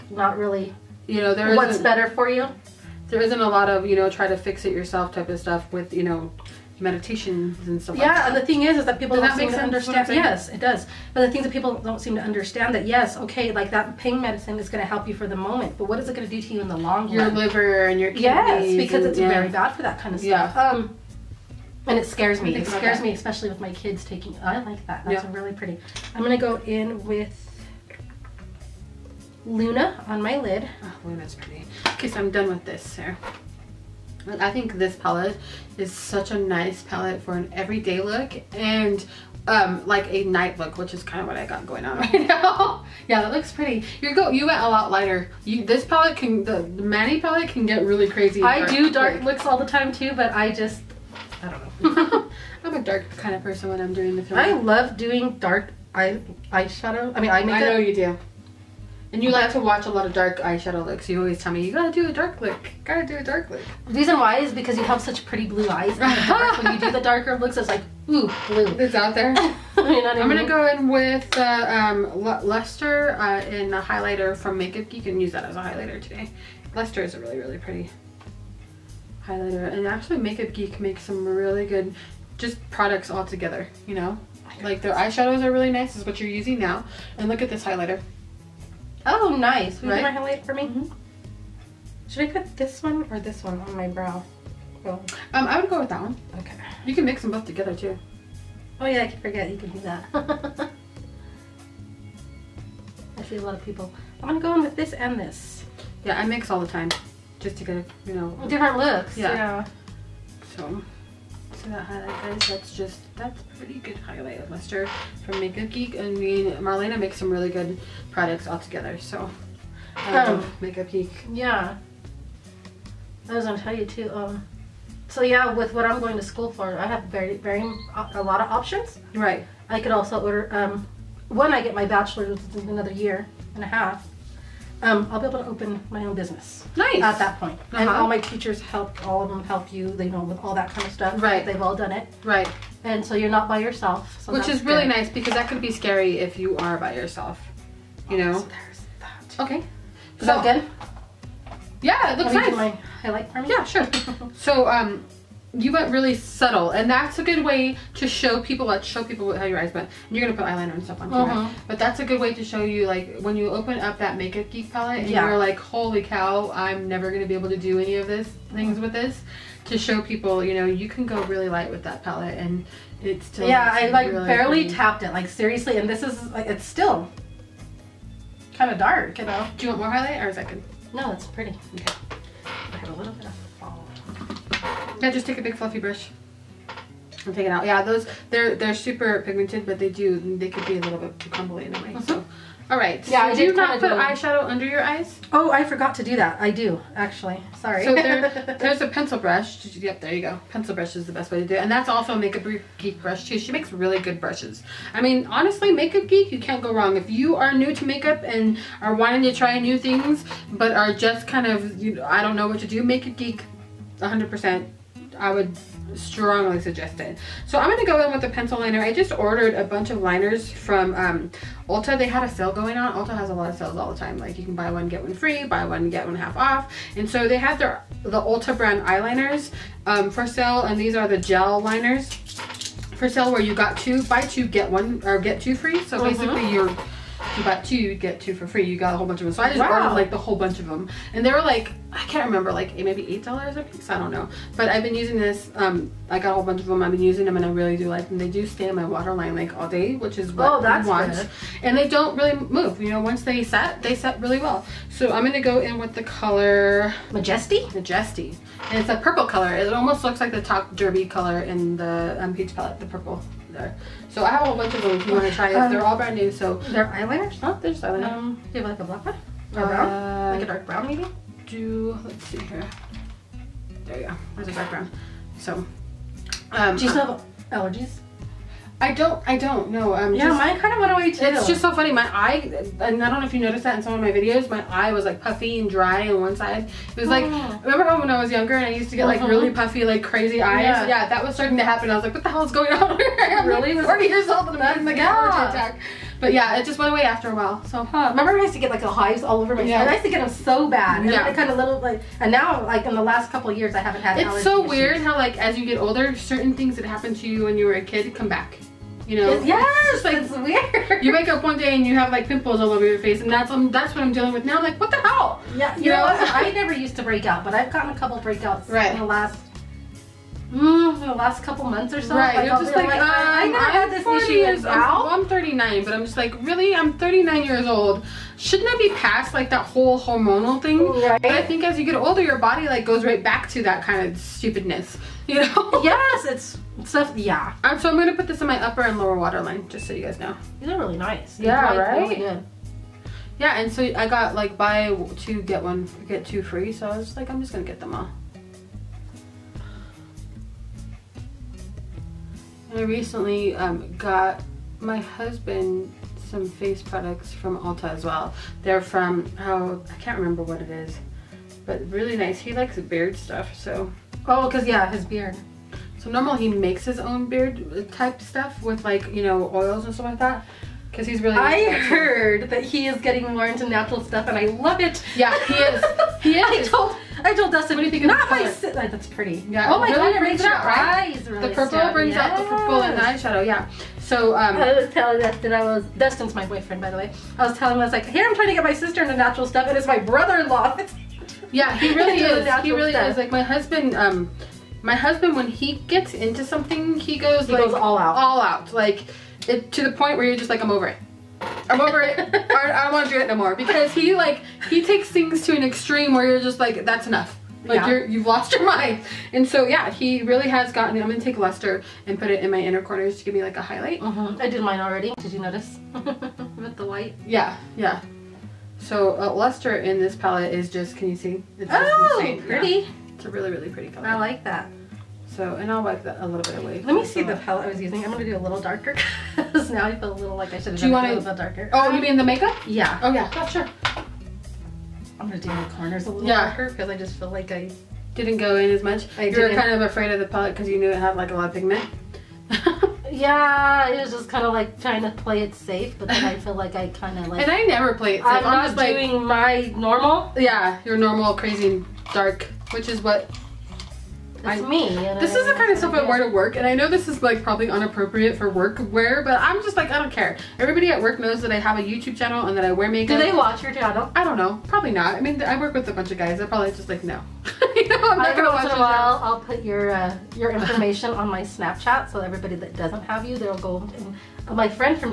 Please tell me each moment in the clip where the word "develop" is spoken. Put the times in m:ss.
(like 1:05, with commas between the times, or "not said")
not said.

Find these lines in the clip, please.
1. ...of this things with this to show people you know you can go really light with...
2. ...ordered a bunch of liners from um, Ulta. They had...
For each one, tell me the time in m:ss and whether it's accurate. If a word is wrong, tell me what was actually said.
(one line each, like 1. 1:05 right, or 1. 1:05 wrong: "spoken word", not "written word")
1. 2:48 right
2. 3:39 right.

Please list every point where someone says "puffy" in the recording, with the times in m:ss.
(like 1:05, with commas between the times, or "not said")
4:45, 4:49.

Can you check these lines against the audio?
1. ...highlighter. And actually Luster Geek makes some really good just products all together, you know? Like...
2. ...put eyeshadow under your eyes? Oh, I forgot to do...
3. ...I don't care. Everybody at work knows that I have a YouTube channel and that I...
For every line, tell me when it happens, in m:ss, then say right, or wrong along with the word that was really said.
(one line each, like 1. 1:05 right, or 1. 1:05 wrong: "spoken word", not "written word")
1. 1:19 wrong: "Makeup", not "Luster"
2. 3:13 right
3. 7:39 right.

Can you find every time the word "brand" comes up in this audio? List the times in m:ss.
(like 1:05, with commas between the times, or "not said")
3:48, 4:25.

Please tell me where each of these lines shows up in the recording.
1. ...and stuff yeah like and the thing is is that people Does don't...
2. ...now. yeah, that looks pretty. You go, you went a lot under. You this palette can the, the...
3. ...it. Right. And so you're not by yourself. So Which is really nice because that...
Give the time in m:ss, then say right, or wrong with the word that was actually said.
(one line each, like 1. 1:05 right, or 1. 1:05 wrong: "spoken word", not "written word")
1. 0:07 right
2. 0:42 wrong: "lighter", not "under"
3. 2:21 right.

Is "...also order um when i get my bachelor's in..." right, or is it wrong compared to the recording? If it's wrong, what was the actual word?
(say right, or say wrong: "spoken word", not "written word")
right.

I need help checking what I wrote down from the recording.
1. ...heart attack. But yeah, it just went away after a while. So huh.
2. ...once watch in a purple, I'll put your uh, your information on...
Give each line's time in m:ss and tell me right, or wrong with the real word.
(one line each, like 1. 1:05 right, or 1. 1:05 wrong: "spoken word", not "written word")
1. 4:55 right
2. 7:48 wrong: "while", not "purple".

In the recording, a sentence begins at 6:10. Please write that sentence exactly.
Because he's really I heard that he is getting more into natural stuff and I love it.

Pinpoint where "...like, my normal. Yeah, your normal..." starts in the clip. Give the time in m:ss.
7:29.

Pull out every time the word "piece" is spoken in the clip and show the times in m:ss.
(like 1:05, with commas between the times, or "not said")
4:03.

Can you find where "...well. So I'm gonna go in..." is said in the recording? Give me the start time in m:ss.
4:14.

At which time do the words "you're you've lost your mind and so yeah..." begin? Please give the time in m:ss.
6:47.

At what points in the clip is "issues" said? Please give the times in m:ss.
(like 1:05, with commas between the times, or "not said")
5:04, 5:24.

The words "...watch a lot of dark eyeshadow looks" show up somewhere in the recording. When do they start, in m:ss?
0:59.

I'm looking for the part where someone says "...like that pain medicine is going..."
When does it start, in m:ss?
0:13.